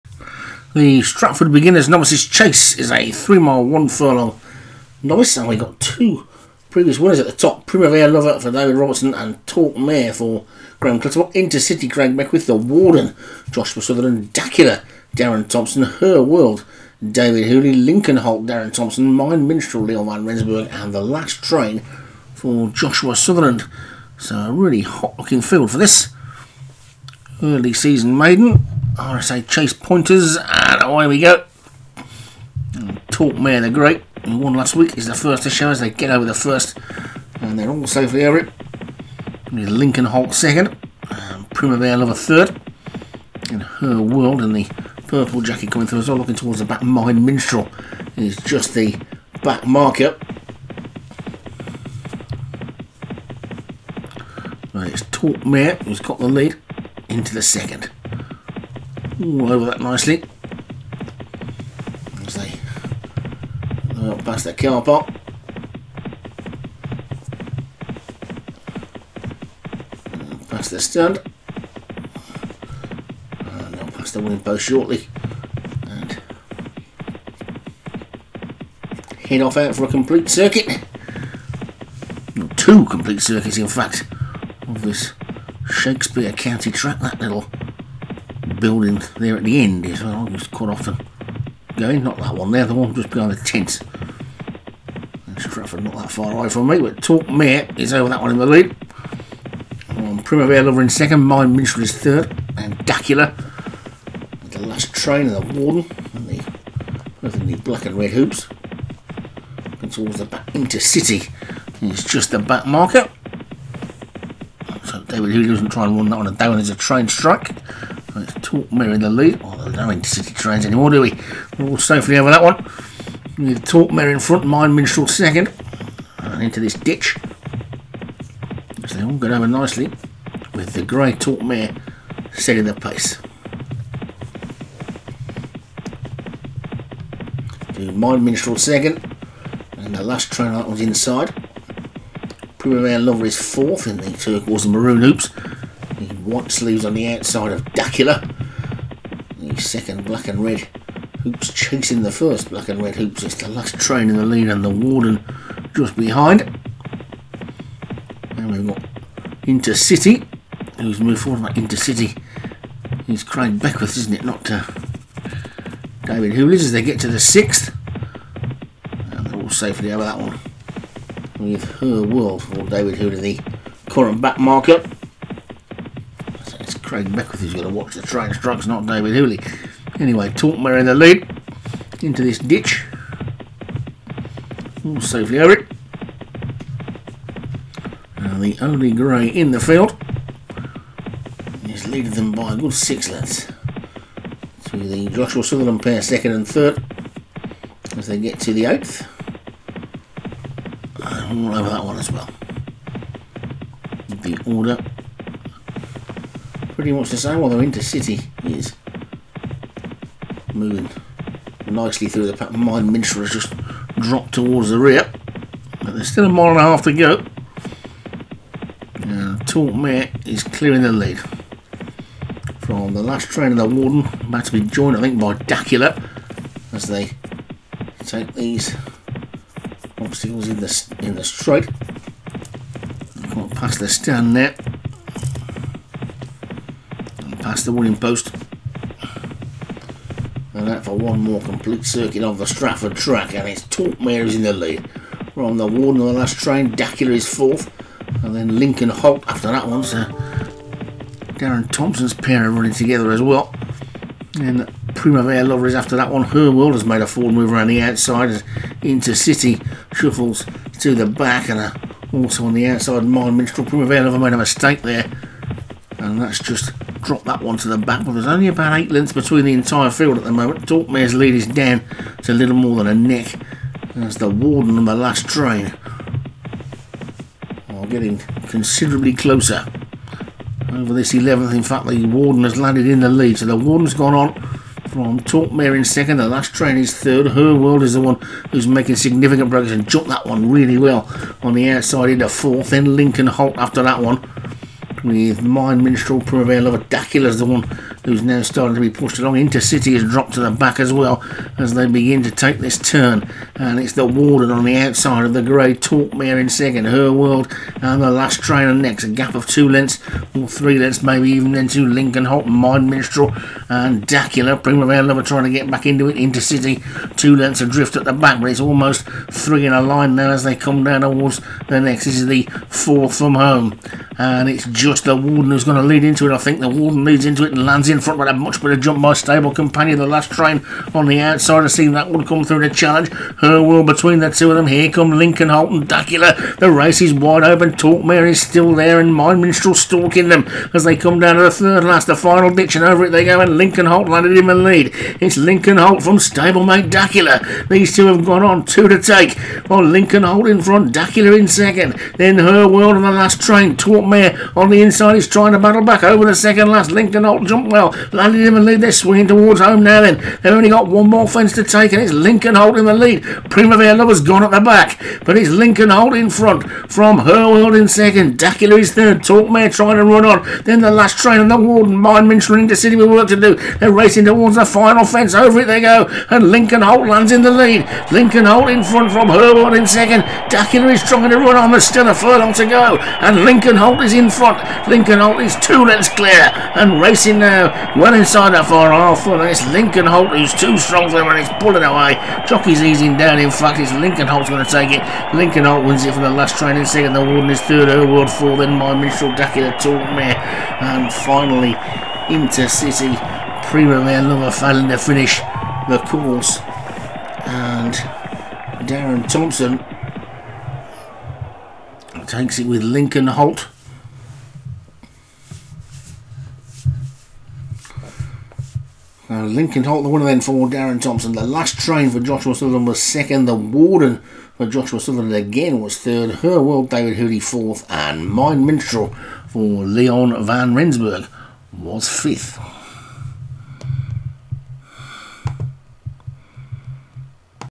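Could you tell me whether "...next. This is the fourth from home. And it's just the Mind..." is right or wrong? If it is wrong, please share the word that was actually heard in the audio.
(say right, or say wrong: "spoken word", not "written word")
wrong: "Warden", not "Mind".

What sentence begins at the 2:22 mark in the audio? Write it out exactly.
Primavera Lover is fourth in the turquoise and maroon hoops.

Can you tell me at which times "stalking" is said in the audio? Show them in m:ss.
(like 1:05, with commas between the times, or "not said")
5:39.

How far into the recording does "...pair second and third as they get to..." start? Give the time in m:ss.
3:15.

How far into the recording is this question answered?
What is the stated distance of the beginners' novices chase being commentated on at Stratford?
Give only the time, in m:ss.
0:03.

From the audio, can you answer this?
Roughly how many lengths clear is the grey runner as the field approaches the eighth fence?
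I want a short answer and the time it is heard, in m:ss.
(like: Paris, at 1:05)
6, at 3:12.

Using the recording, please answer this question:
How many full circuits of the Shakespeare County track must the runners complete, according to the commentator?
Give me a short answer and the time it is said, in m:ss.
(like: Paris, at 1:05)
2, at 1:22.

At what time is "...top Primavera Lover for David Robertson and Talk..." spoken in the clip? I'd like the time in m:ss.
0:07.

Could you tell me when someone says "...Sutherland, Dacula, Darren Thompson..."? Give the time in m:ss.
0:13.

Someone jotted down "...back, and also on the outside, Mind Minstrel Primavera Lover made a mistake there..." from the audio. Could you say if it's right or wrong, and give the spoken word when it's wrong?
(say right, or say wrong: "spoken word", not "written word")
right.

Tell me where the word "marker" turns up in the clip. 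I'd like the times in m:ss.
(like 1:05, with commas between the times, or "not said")
0:49, 1:52, 2:54.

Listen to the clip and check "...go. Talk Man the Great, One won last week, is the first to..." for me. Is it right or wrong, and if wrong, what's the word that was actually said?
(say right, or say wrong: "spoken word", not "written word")
right.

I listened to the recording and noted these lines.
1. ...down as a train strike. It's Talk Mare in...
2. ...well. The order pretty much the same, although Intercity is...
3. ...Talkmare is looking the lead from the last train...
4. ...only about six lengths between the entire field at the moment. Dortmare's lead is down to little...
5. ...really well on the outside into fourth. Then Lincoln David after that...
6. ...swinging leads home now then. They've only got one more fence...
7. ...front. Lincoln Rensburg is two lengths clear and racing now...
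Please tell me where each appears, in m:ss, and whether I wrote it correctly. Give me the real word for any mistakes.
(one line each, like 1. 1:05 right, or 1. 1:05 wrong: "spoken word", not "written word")
1. 1:56 right
2. 3:22 right
3. 3:39 wrong: "clearing", not "looking"
4. 4:28 wrong: "eight", not "six"
5. 4:50 wrong: "Holt", not "David"
6. 5:58 wrong: "towards", not "leads"
7. 6:24 wrong: "Holt", not "Rensburg".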